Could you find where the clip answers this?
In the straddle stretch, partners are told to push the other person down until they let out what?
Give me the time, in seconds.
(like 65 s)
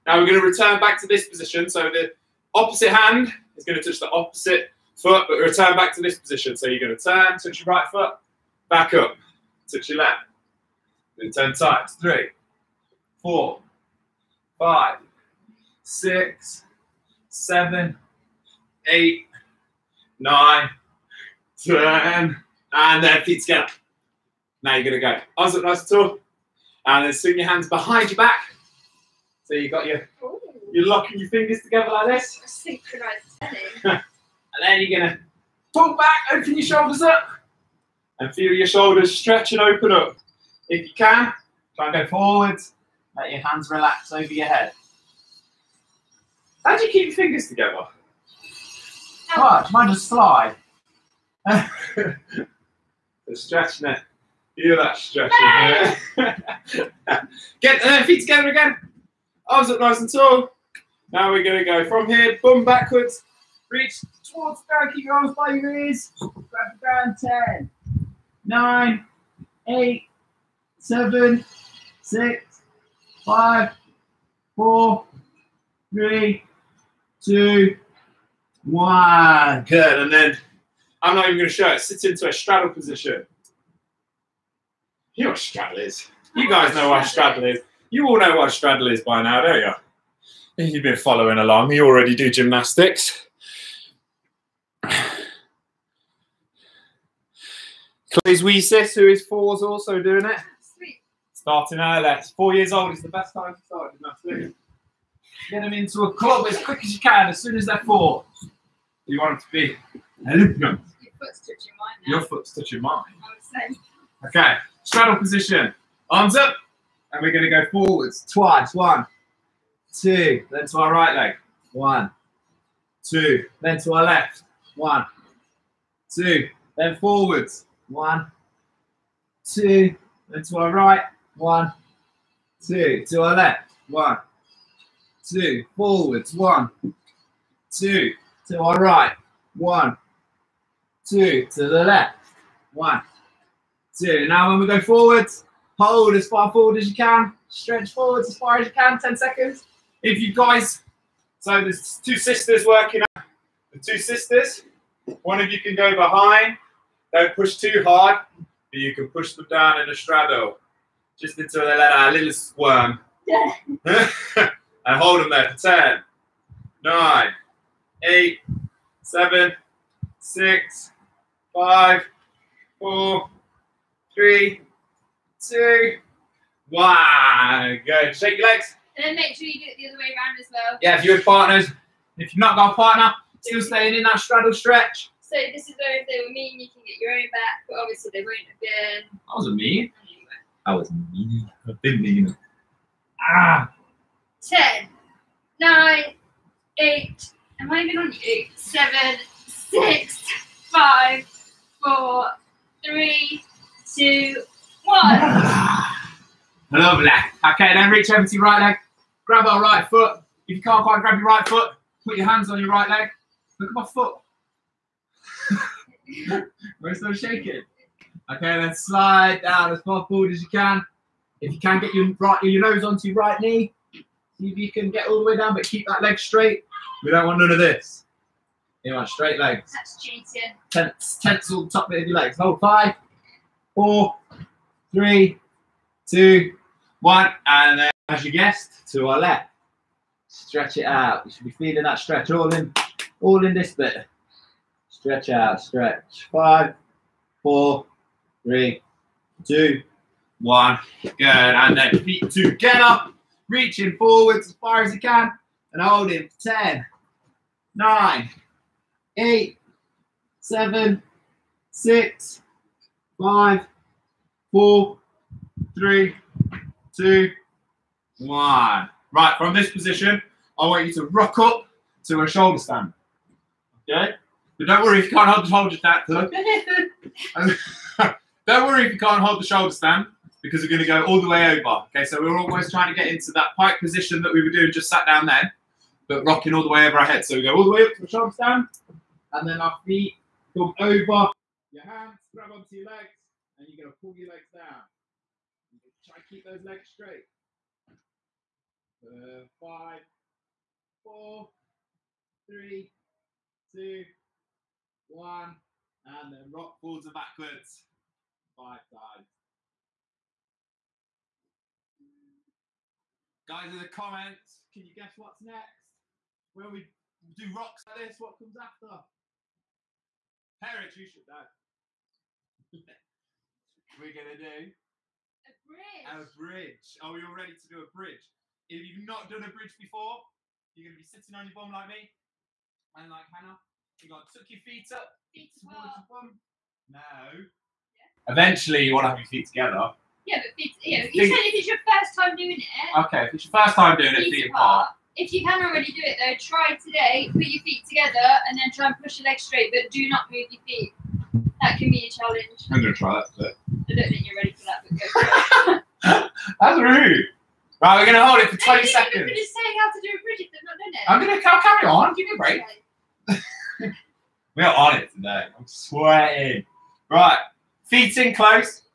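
162 s.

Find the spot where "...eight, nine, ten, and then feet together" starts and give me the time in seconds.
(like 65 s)
18 s.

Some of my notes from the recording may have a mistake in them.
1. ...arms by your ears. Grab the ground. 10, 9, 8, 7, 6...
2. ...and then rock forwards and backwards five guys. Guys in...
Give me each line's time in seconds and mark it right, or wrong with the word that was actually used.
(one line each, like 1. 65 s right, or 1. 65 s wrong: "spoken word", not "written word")
1. 65 s right
2. 306 s right.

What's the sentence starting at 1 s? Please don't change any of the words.
So the opposite hand is going to touch the opposite foot, but return back to this position.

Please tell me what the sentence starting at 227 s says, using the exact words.
We don't want none of this.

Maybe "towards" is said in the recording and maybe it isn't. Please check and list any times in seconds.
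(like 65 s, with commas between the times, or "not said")
64 s, 335 s.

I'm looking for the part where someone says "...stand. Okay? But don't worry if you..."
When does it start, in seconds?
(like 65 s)
272 s.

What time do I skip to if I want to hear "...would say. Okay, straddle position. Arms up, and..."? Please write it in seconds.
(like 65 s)
113 s.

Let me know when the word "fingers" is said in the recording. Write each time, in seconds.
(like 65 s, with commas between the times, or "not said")
31 s, 47 s.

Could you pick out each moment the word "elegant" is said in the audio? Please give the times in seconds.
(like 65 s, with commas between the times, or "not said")
110 s.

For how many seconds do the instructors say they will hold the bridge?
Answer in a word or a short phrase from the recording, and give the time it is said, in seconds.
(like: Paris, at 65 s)
20 seconds, at 358 s.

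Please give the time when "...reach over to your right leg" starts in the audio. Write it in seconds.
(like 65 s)
207 s.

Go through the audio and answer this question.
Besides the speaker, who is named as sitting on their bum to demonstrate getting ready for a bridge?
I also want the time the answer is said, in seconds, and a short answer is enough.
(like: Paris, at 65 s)
Hannah, at 333 s.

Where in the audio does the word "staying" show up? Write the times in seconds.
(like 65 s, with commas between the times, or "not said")
183 s.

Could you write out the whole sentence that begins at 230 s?
Tense, tense all the top bit of your legs.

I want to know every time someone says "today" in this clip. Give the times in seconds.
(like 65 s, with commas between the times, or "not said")
346 s, 365 s.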